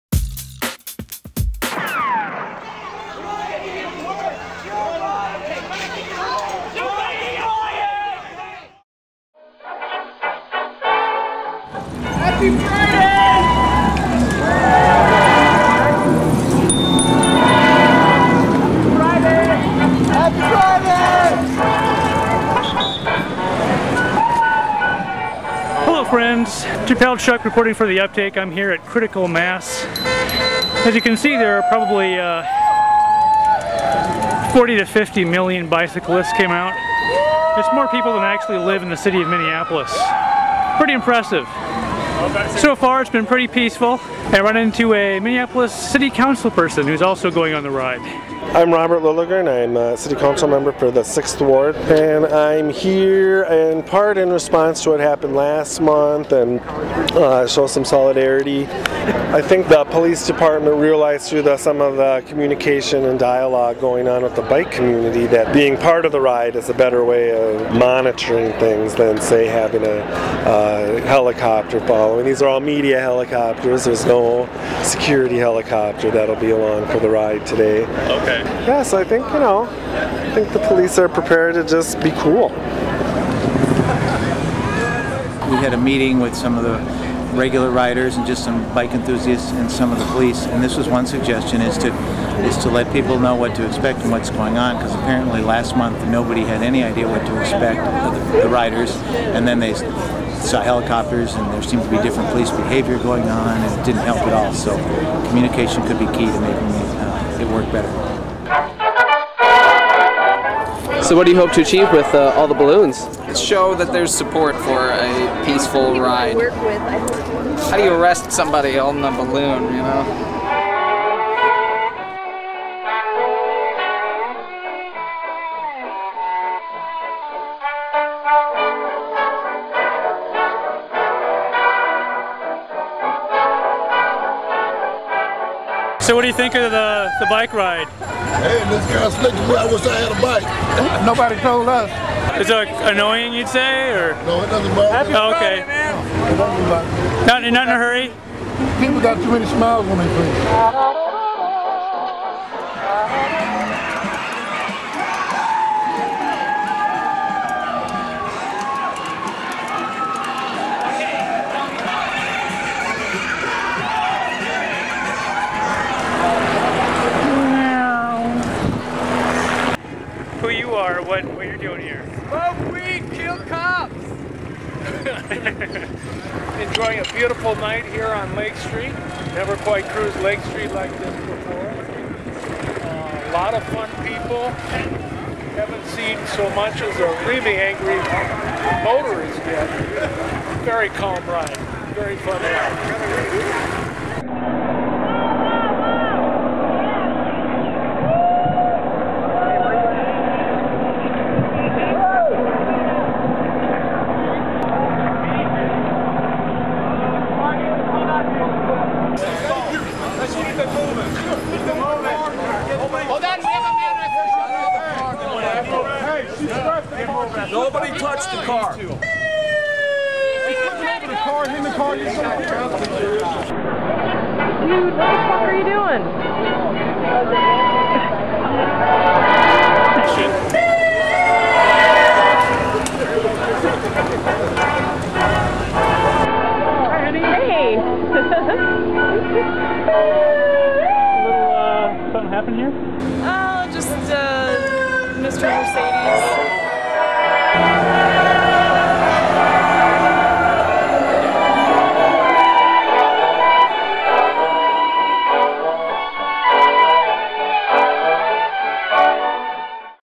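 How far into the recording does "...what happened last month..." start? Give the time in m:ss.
0:54.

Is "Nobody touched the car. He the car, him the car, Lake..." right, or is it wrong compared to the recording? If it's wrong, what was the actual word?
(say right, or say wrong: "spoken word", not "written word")
wrong: "Dude", not "Lake".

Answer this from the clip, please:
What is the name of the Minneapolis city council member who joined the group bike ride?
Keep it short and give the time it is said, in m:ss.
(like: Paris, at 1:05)
Robert Lilligren, at 0:48.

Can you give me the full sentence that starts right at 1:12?
These are all media helicopters, there's no security helicopter that'll be along for the ride today.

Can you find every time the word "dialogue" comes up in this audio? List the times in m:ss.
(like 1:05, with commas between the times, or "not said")
1:03.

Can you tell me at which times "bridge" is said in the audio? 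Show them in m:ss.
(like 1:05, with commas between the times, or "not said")
not said.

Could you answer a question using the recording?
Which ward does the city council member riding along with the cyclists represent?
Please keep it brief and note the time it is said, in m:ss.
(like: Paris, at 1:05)
6th Ward, at 0:51.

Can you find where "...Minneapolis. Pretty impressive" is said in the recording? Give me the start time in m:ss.
0:39.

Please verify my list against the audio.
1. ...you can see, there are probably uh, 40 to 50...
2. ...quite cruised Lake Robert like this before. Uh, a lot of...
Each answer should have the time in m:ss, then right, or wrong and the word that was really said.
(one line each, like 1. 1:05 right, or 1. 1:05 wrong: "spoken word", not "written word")
1. 0:30 right
2. 2:59 wrong: "Street", not "Robert".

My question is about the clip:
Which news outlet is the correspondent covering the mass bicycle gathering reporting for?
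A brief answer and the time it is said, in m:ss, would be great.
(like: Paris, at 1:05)
The Uptake, at 0:27.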